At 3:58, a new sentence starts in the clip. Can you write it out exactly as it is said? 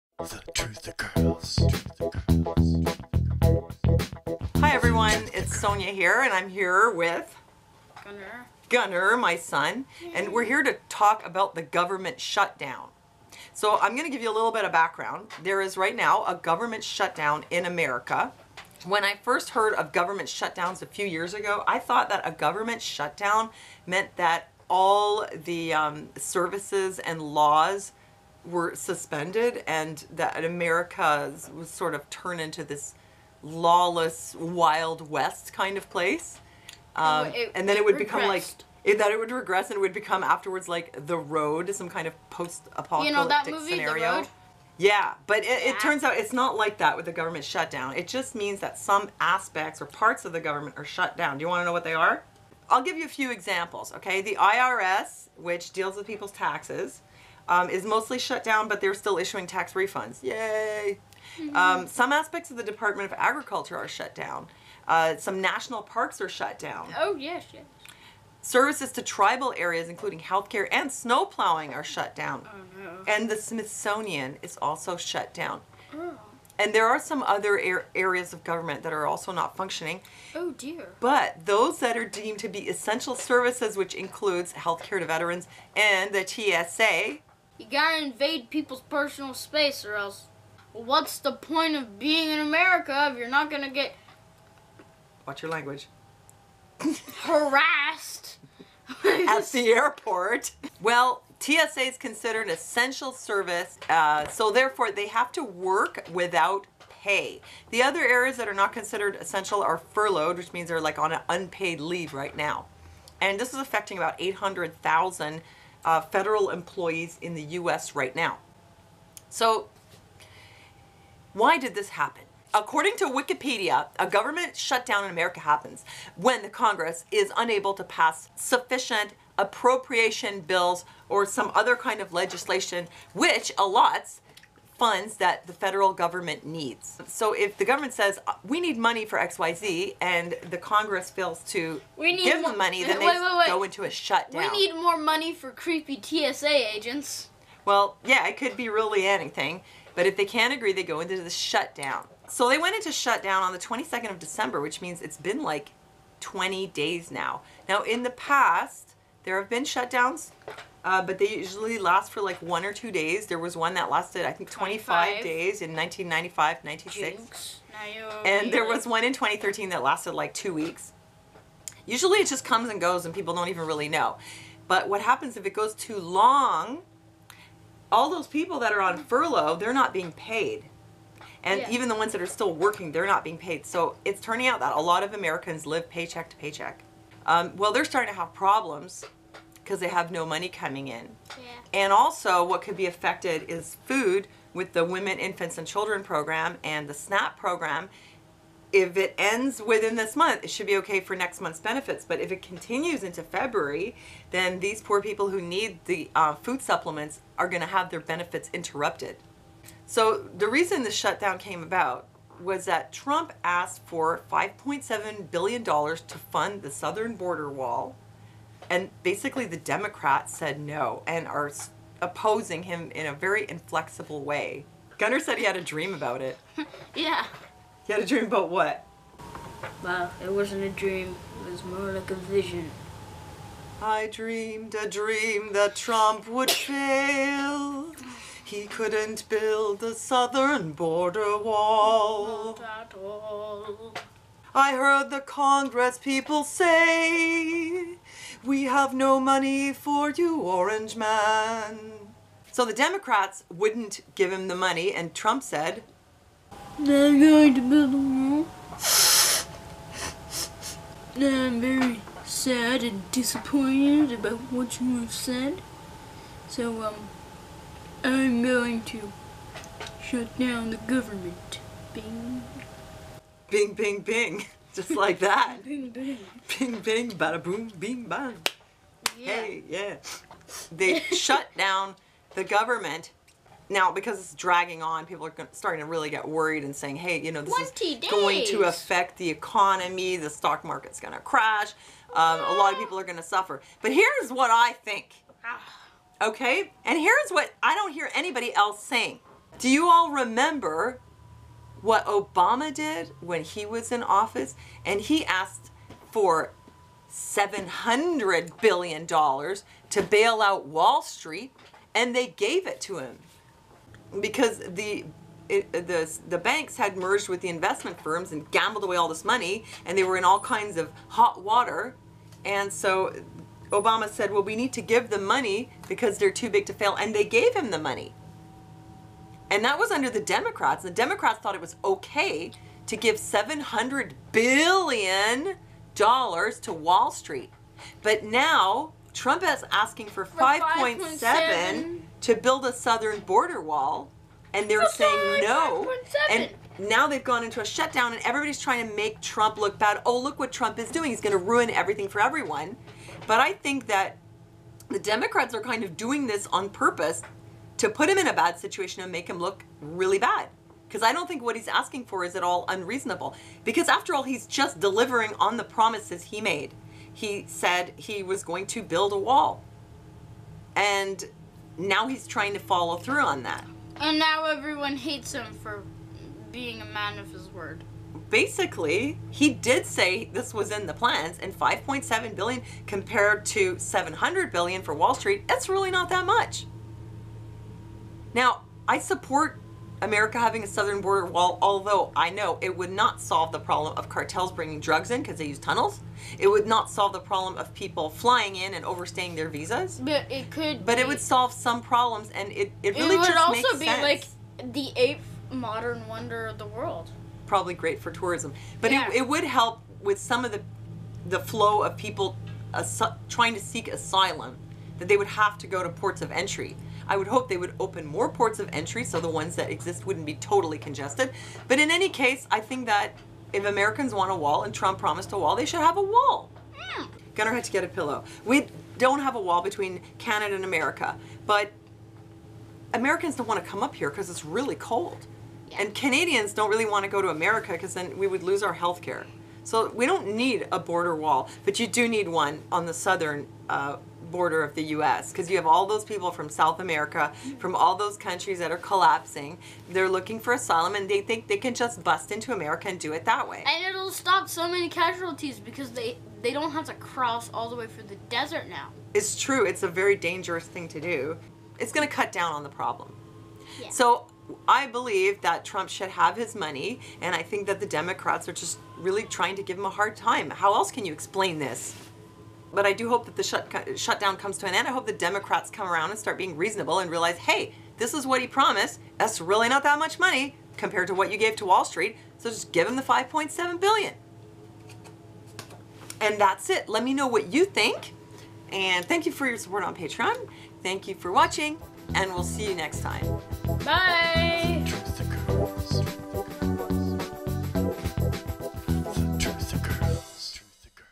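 He couldn't build a southern border wall.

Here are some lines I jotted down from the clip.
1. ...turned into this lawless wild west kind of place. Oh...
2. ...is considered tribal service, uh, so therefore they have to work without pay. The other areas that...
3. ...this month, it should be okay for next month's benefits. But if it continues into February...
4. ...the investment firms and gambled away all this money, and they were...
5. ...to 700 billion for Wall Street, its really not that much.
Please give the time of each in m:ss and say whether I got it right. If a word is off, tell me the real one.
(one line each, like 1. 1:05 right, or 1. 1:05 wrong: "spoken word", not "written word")
1. 0:32 right
2. 1:41 wrong: "essential", not "tribal"
3. 3:19 right
4. 5:17 right
5. 6:23 right.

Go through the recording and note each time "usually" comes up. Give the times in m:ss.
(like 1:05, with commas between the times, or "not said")
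2:41, 2:51.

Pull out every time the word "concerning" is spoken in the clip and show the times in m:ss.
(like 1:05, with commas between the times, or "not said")
not said.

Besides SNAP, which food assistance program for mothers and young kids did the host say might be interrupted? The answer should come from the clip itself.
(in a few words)
Women, Infants, and Children.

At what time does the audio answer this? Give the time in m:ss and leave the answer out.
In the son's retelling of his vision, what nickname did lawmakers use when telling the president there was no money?
4:10.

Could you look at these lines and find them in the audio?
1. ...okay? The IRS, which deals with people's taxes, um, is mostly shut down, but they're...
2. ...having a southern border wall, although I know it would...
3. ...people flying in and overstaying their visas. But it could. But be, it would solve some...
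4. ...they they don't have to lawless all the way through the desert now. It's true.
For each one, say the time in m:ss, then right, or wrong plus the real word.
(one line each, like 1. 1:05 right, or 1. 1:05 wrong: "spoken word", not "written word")
1. 0:53 right
2. 6:30 right
3. 6:37 right
4. 7:35 wrong: "cross", not "lawless".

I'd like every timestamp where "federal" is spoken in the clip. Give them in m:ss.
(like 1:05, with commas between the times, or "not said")
1:56, 2:15.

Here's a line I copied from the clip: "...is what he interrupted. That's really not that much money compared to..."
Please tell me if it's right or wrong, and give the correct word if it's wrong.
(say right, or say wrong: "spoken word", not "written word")
wrong: "promised", not "interrupted".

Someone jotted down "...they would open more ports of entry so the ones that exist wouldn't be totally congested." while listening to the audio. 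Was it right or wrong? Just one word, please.
right.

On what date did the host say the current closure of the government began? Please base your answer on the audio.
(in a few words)
22nd of December.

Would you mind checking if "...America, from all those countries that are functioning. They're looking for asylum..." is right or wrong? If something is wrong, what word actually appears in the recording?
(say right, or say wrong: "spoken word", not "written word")
wrong: "collapsing", not "functioning".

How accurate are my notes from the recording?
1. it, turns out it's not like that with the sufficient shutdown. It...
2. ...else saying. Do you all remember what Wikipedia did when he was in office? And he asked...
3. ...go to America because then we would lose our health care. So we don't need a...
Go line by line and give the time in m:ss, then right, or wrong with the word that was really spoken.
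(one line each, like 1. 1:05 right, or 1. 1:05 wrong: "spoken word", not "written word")
1. 0:45 wrong: "government", not "sufficient"
2. 4:58 wrong: "Obama", not "Wikipedia"
3. 7:17 right.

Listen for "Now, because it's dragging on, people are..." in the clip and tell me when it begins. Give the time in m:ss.
4:43.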